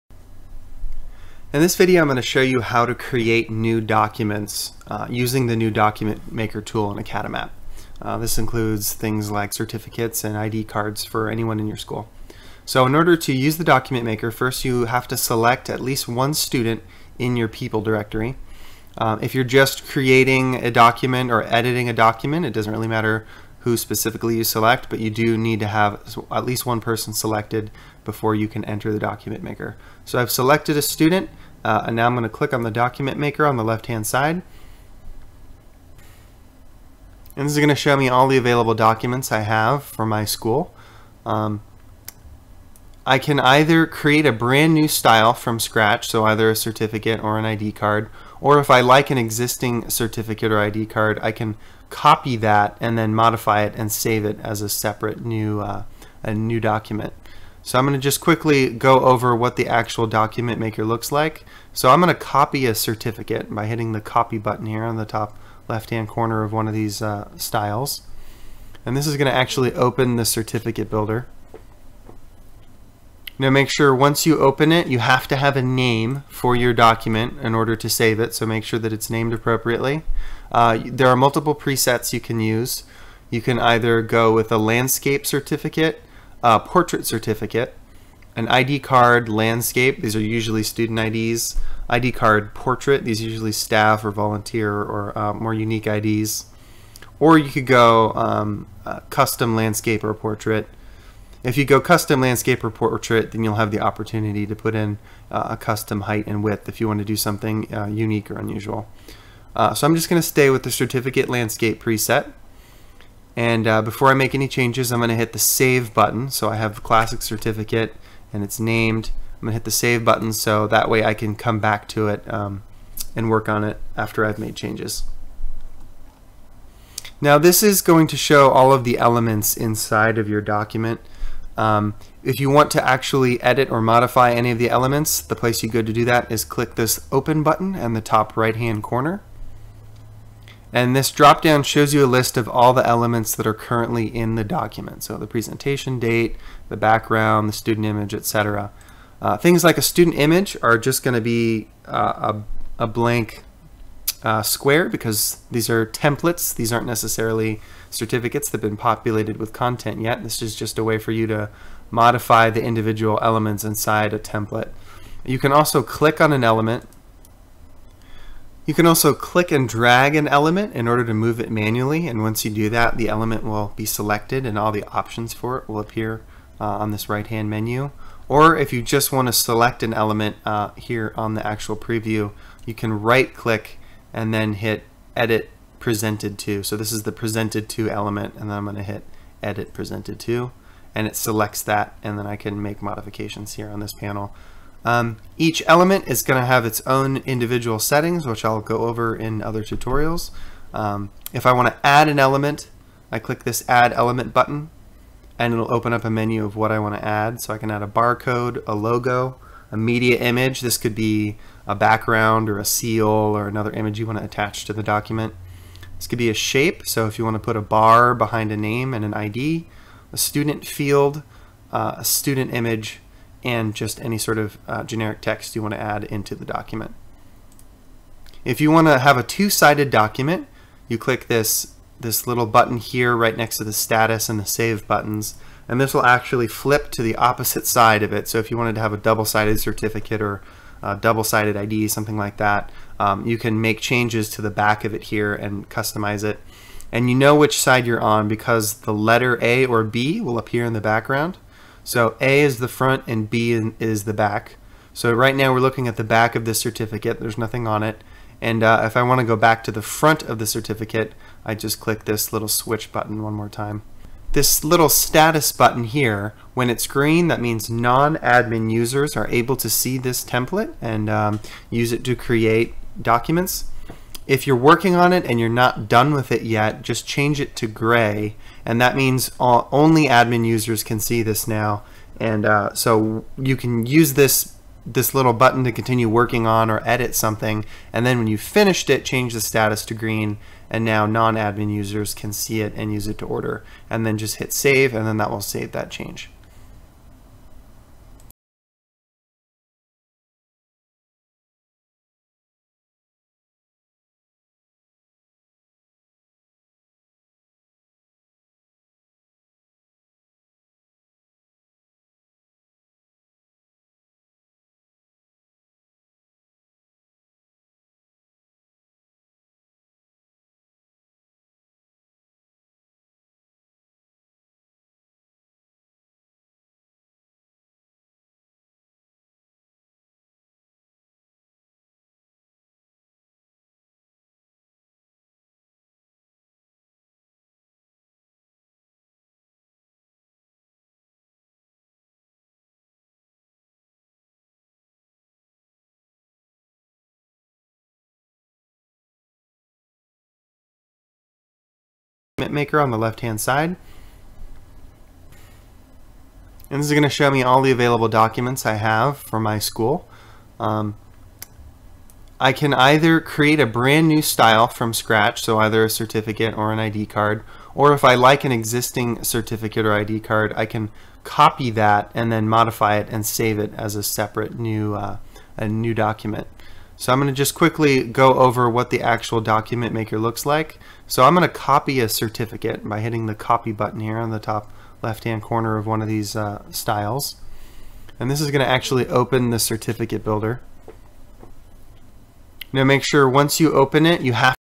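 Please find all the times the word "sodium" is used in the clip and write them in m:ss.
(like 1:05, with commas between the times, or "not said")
not said.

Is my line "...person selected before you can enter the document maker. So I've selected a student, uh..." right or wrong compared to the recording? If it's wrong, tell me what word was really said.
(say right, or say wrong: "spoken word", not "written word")
right.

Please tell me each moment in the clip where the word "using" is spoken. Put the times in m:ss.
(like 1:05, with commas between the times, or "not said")
0:05.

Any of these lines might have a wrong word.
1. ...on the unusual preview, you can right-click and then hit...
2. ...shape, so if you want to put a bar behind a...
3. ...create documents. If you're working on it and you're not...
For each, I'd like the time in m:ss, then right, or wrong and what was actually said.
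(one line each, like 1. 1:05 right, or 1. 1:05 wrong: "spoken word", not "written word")
1. 3:01 wrong: "actual", not "unusual"
2. 3:36 right
3. 4:32 right.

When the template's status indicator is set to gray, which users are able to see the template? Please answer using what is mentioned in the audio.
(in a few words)
only admin users.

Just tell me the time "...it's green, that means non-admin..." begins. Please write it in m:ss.
4:26.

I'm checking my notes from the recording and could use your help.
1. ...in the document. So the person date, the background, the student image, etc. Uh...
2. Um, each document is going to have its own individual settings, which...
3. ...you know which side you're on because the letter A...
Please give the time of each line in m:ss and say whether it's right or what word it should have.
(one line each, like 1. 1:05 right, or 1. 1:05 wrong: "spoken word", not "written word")
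1. 2:24 wrong: "presentation", not "person"
2. 3:14 wrong: "element", not "document"
3. 4:07 right.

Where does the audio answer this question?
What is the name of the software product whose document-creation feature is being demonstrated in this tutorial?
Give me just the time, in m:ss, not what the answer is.
0:07.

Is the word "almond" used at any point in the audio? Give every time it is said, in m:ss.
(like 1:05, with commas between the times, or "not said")
not said.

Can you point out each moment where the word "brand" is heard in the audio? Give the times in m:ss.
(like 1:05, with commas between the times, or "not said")
0:44, 6:03.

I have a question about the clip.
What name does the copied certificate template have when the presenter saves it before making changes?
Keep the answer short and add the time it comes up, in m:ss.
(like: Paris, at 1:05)
classic certificate, at 1:56.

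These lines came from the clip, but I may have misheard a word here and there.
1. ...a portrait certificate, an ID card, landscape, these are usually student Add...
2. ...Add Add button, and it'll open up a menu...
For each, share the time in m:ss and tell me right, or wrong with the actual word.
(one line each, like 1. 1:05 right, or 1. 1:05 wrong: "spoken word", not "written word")
1. 1:26 wrong: "IDs", not "Add"
2. 3:23 wrong: "Element", not "Add".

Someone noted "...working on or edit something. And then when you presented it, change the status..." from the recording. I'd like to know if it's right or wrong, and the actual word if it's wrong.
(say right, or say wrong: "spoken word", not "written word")
wrong: "finished", not "presented".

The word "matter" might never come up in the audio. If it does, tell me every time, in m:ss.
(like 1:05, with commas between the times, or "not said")
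0:22.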